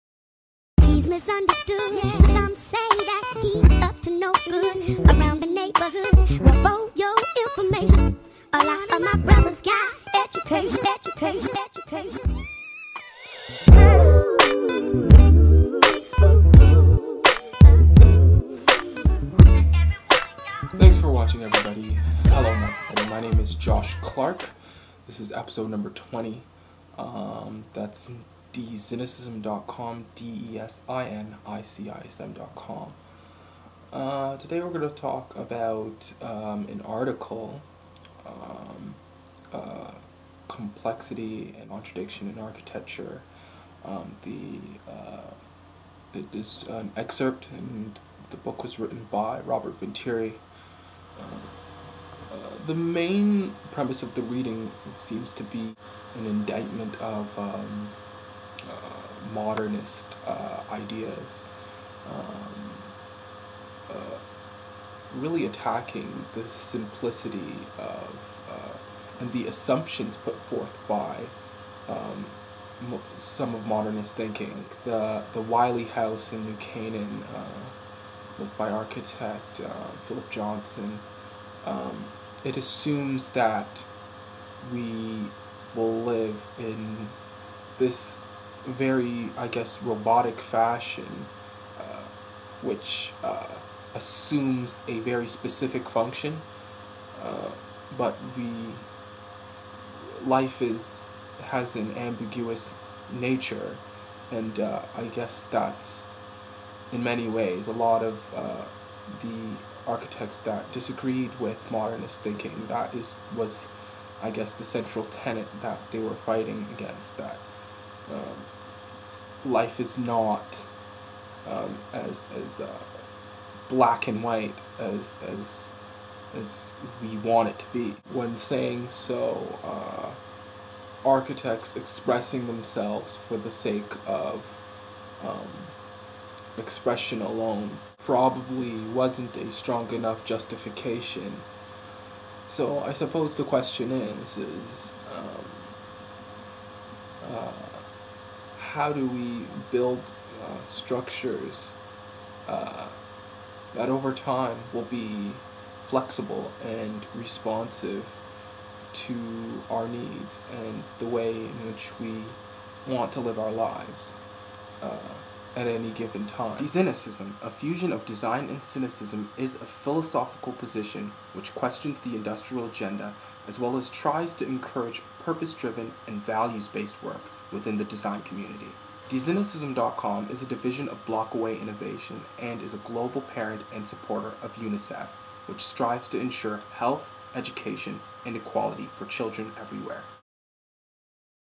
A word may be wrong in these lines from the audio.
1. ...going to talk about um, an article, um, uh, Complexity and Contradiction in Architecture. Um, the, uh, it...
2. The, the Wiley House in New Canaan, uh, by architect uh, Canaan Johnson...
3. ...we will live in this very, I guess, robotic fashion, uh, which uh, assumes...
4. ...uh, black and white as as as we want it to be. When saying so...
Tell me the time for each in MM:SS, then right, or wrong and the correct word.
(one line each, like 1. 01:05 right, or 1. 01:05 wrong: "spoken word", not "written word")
1. 00:34 right
2. 01:14 wrong: "Philip", not "Canaan"
3. 01:24 right
4. 02:02 right.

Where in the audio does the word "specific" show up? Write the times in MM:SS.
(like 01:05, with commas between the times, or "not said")
01:35.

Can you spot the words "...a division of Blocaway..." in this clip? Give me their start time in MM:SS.
03:00.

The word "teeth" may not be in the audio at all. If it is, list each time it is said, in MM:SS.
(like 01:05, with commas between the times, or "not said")
not said.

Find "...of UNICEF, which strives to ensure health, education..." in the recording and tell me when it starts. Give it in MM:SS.
03:04.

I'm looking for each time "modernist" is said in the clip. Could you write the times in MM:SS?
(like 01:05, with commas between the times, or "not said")
00:59, 01:13, 01:51.